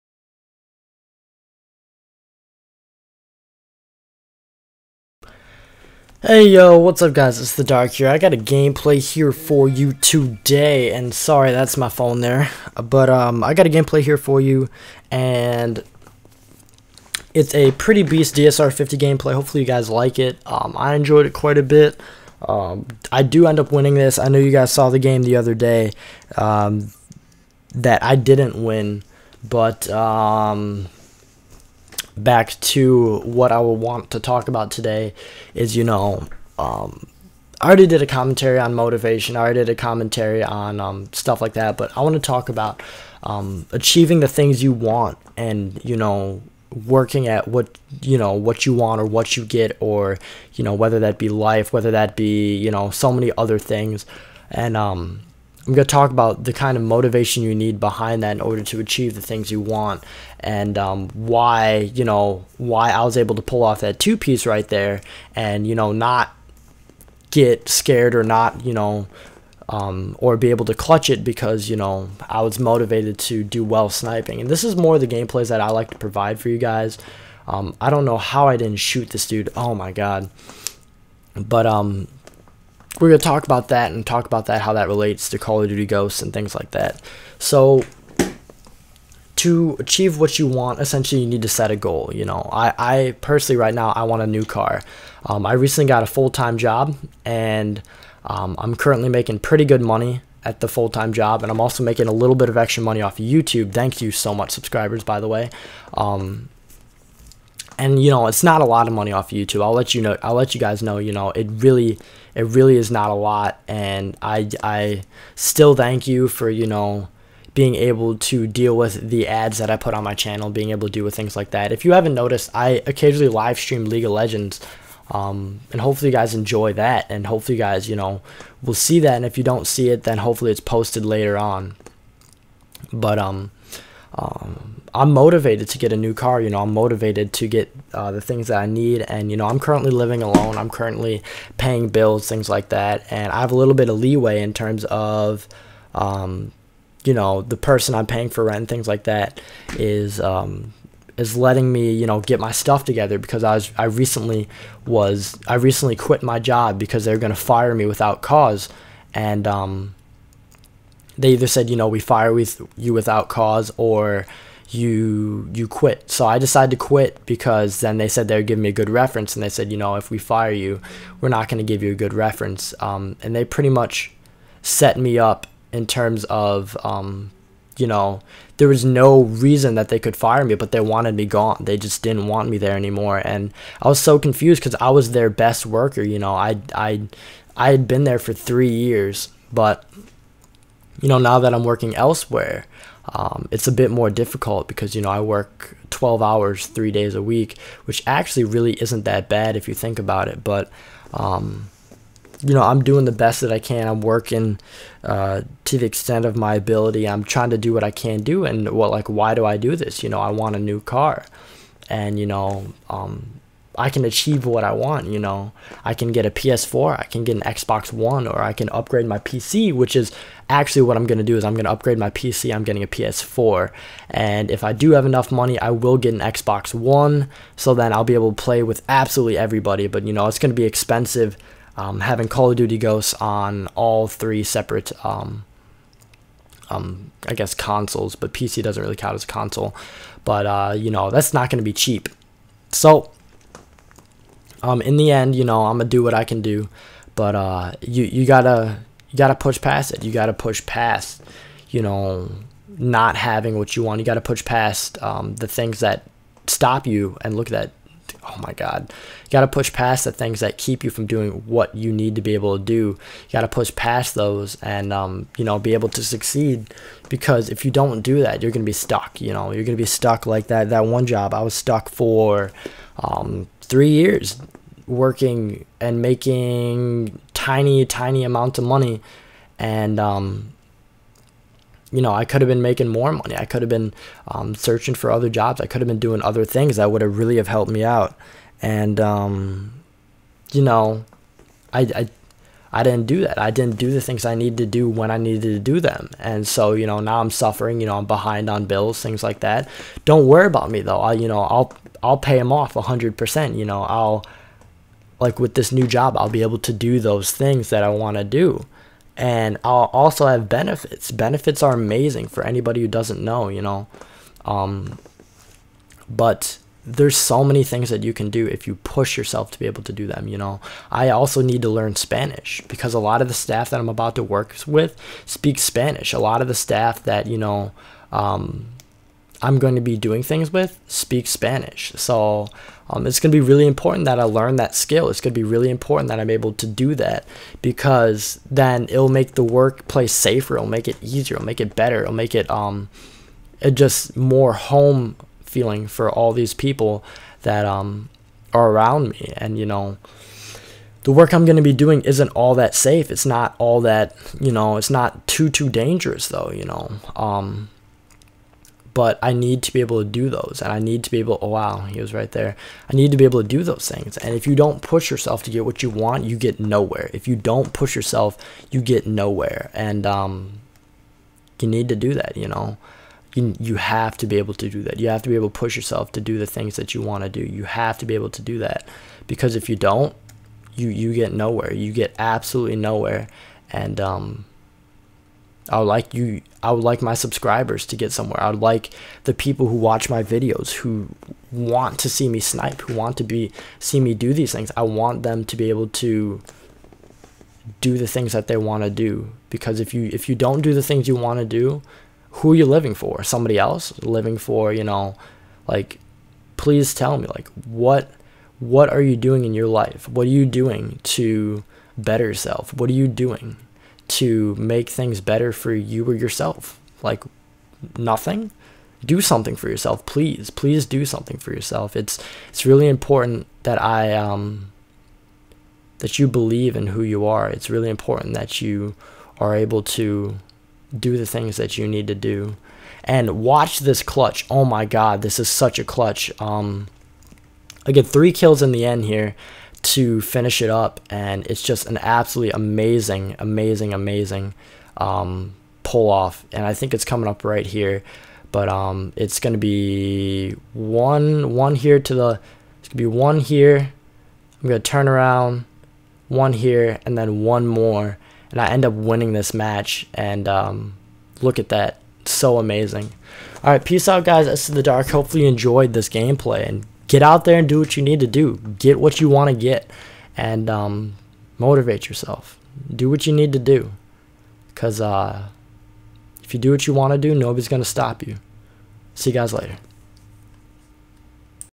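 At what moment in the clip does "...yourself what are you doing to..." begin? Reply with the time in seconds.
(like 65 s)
412 s.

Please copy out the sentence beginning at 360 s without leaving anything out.
And I need to be able, oh, wow, he was right there.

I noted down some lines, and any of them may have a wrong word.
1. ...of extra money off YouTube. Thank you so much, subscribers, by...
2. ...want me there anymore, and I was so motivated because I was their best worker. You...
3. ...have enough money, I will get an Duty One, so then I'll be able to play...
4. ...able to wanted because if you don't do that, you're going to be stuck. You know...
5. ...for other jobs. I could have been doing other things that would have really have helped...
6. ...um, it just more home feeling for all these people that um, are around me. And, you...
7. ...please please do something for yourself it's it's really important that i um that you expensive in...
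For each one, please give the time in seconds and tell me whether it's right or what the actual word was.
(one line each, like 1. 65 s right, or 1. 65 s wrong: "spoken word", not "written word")
1. 102 s right
2. 182 s wrong: "confused", not "motivated"
3. 224 s wrong: "Xbox", not "Duty"
4. 265 s wrong: "succeed", not "wanted"
5. 284 s right
6. 342 s right
7. 420 s wrong: "believe", not "expensive".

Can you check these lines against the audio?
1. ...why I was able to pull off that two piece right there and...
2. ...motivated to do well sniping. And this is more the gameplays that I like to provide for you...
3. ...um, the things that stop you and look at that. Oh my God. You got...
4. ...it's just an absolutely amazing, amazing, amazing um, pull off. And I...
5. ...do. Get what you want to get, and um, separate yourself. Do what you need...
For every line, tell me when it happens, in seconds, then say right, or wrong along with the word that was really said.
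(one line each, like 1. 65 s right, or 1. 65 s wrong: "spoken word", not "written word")
1. 62 s right
2. 72 s right
3. 255 s right
4. 441 s right
5. 468 s wrong: "motivate", not "separate".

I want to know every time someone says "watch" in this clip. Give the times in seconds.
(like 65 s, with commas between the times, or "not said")
389 s, 433 s.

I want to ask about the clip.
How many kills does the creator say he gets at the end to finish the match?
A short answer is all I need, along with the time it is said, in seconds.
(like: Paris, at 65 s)
3, at 438 s.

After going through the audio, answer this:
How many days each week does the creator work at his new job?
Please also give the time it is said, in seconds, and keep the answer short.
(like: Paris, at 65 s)
3, at 196 s.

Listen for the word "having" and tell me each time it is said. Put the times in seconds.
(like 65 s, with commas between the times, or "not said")
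232 s, 253 s.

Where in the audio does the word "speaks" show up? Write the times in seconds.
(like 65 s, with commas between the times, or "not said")
325 s, 330 s.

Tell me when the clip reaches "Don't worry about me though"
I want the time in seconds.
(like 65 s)
300 s.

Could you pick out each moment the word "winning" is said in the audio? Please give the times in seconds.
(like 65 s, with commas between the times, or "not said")
23 s, 458 s.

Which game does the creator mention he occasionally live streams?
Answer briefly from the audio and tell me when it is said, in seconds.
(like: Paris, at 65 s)
League of Legends, at 123 s.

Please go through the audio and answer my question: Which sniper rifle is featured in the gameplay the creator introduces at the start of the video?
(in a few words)
DSR 50.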